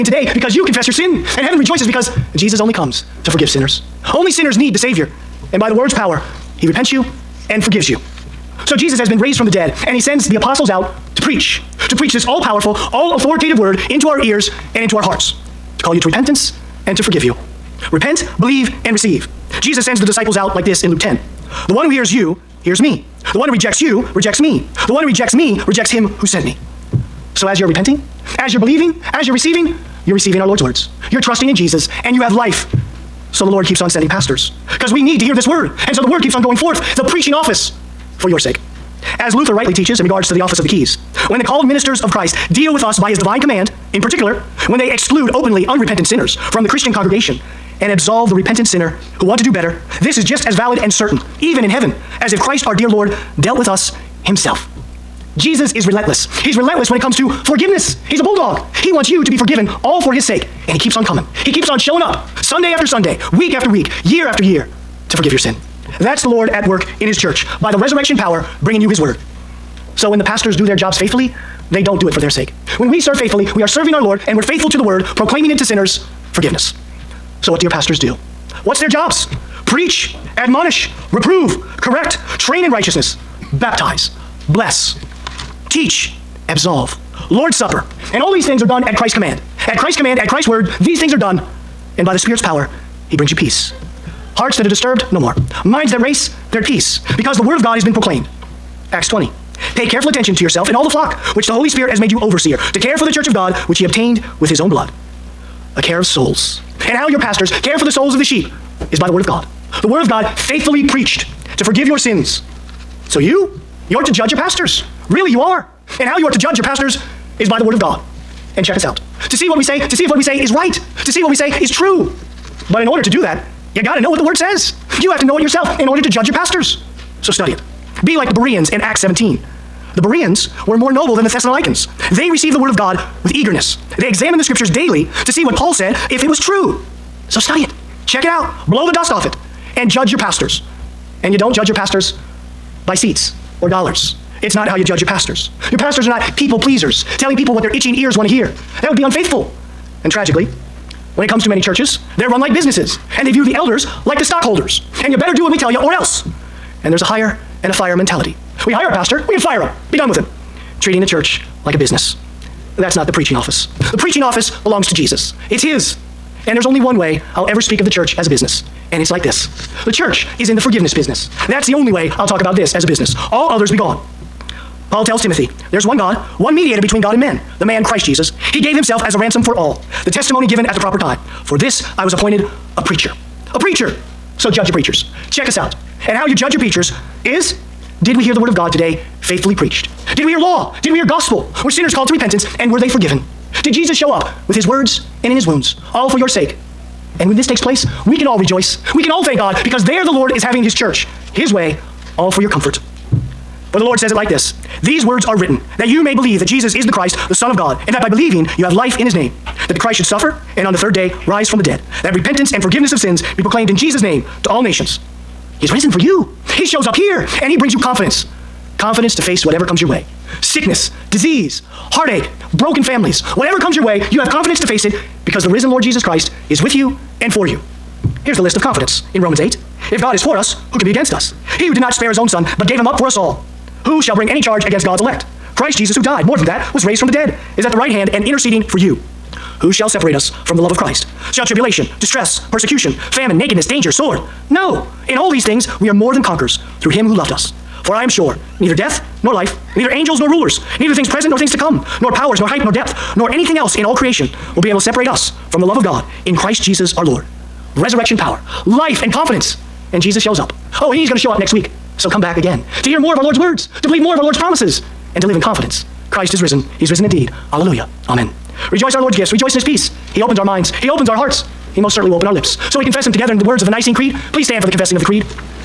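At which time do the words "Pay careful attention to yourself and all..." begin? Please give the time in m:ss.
1:39.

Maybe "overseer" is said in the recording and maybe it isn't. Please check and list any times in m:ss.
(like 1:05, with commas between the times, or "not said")
1:42.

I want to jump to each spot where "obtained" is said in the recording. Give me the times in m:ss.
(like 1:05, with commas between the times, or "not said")
1:43.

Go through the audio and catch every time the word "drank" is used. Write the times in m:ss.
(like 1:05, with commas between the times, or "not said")
not said.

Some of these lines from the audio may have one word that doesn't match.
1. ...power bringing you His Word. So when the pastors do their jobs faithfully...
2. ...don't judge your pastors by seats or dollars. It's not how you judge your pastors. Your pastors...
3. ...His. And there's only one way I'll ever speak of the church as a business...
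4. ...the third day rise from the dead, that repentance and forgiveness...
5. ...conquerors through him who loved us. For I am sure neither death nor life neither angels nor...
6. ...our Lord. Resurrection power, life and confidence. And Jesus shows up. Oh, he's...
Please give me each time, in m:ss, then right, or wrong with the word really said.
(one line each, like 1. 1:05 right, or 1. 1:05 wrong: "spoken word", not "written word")
1. 1:08 right
2. 2:21 right
3. 2:45 right
4. 3:30 right
5. 4:06 right
6. 4:16 right.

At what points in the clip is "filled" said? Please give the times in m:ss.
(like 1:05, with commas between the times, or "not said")
not said.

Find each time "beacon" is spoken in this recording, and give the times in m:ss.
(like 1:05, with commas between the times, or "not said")
not said.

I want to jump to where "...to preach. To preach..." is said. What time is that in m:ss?
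0:11.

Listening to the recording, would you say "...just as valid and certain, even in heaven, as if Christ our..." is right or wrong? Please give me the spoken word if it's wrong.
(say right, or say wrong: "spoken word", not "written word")
right.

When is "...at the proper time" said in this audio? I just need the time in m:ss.
3:00.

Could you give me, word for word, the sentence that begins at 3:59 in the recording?
Who shall separate us from the love of Christ?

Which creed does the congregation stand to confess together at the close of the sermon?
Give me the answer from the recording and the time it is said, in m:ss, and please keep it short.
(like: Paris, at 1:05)
Nicene Creed, at 4:33.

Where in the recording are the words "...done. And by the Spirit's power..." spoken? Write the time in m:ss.
1:31.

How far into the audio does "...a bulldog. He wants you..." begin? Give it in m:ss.
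0:58.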